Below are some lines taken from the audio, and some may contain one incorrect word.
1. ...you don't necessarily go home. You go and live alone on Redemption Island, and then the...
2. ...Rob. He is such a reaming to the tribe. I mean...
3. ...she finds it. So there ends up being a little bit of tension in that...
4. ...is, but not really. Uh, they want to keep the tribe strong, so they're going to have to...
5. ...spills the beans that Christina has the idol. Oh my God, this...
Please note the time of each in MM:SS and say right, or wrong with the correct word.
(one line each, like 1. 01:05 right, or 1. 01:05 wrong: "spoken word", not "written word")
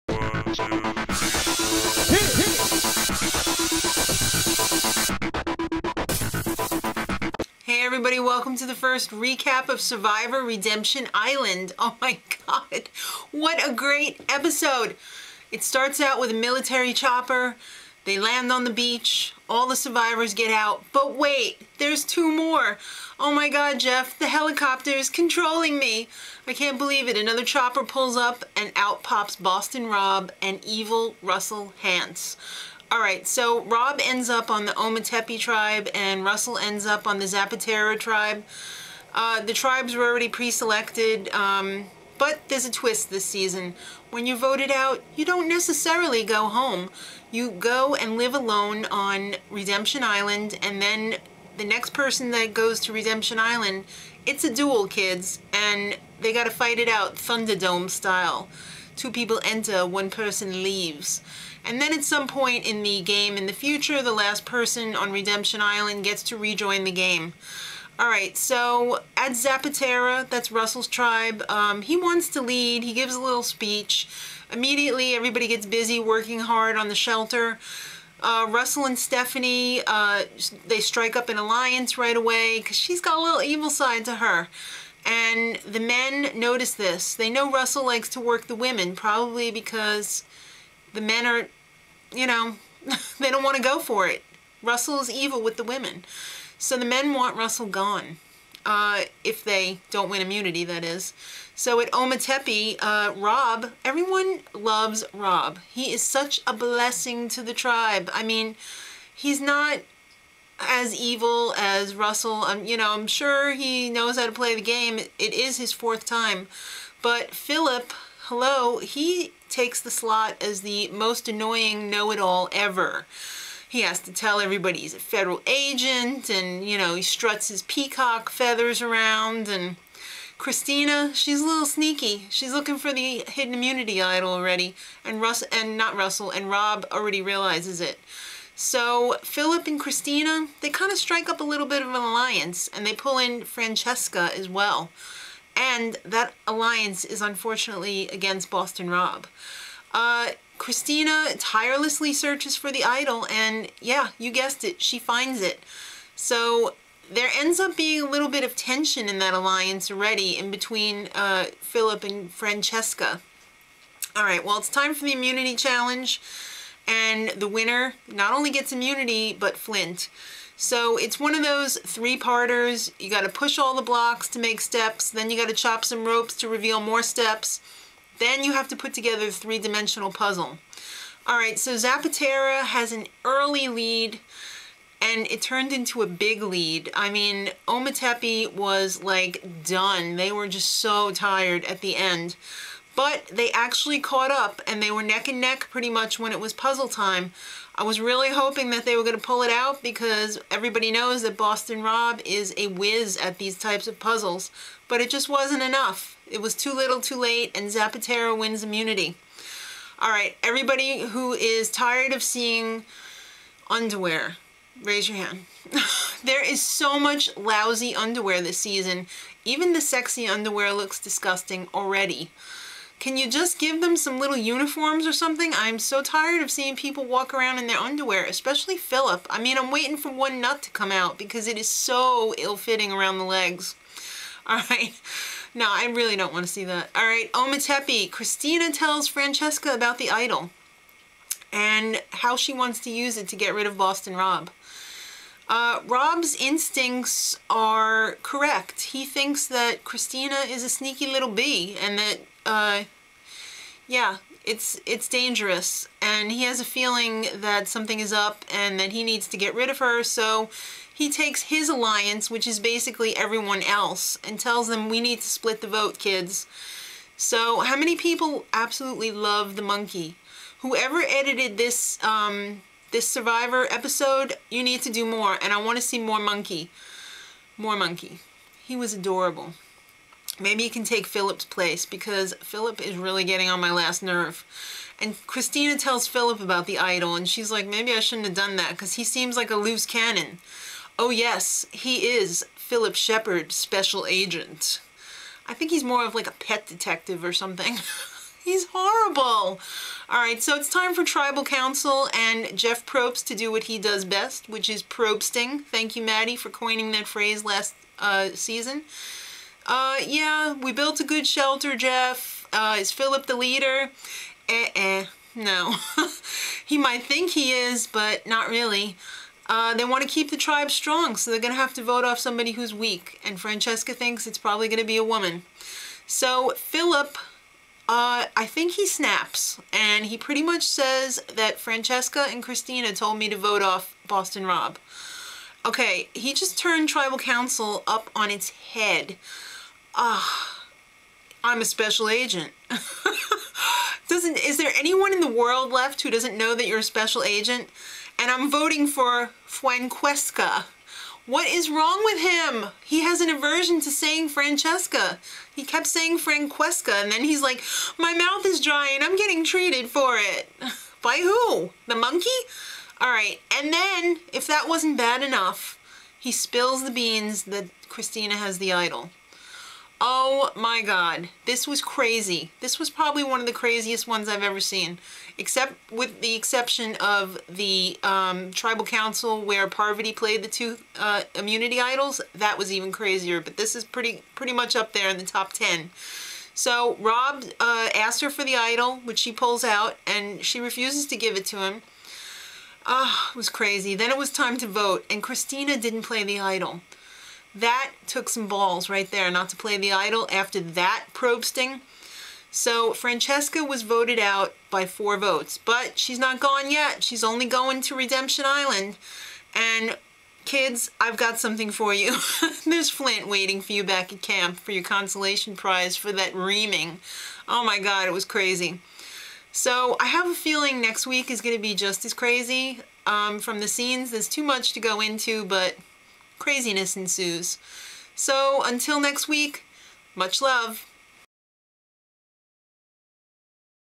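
1. 00:45 right
2. 01:45 wrong: "blessing", not "reaming"
3. 02:34 right
4. 05:17 right
5. 06:06 right.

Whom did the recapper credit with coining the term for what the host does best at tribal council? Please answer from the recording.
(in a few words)
Maddie.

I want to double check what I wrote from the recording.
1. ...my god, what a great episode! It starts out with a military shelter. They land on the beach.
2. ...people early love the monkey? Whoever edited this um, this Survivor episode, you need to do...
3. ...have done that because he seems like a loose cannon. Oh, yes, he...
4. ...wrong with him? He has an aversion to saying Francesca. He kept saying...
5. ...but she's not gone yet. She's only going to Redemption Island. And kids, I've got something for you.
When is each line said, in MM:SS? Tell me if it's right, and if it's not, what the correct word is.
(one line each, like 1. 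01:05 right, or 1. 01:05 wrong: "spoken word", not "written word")
1. 00:11 wrong: "chopper", not "shelter"
2. 04:27 wrong: "absolutely", not "early"
3. 04:48 right
4. 05:51 right
5. 06:45 right.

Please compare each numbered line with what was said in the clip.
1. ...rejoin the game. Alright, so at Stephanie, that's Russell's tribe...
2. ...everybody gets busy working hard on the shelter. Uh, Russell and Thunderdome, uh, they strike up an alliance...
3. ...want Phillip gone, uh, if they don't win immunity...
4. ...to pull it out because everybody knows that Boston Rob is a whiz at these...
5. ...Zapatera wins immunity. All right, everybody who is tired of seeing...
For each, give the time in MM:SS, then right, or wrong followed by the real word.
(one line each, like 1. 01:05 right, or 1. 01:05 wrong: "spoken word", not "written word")
1. 01:06 wrong: "Zapatera", not "Stephanie"
2. 01:15 wrong: "Stephanie", not "Thunderdome"
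3. 01:37 wrong: "Russell", not "Phillip"
4. 03:19 right
5. 03:27 right.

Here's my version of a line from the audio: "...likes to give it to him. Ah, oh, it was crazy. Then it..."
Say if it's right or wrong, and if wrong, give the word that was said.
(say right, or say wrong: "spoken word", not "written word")
wrong: "refuses", not "likes".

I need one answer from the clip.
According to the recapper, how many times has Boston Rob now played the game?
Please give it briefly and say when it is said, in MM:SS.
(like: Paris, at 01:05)
4, at 01:55.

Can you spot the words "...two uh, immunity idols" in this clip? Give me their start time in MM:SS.
06:20.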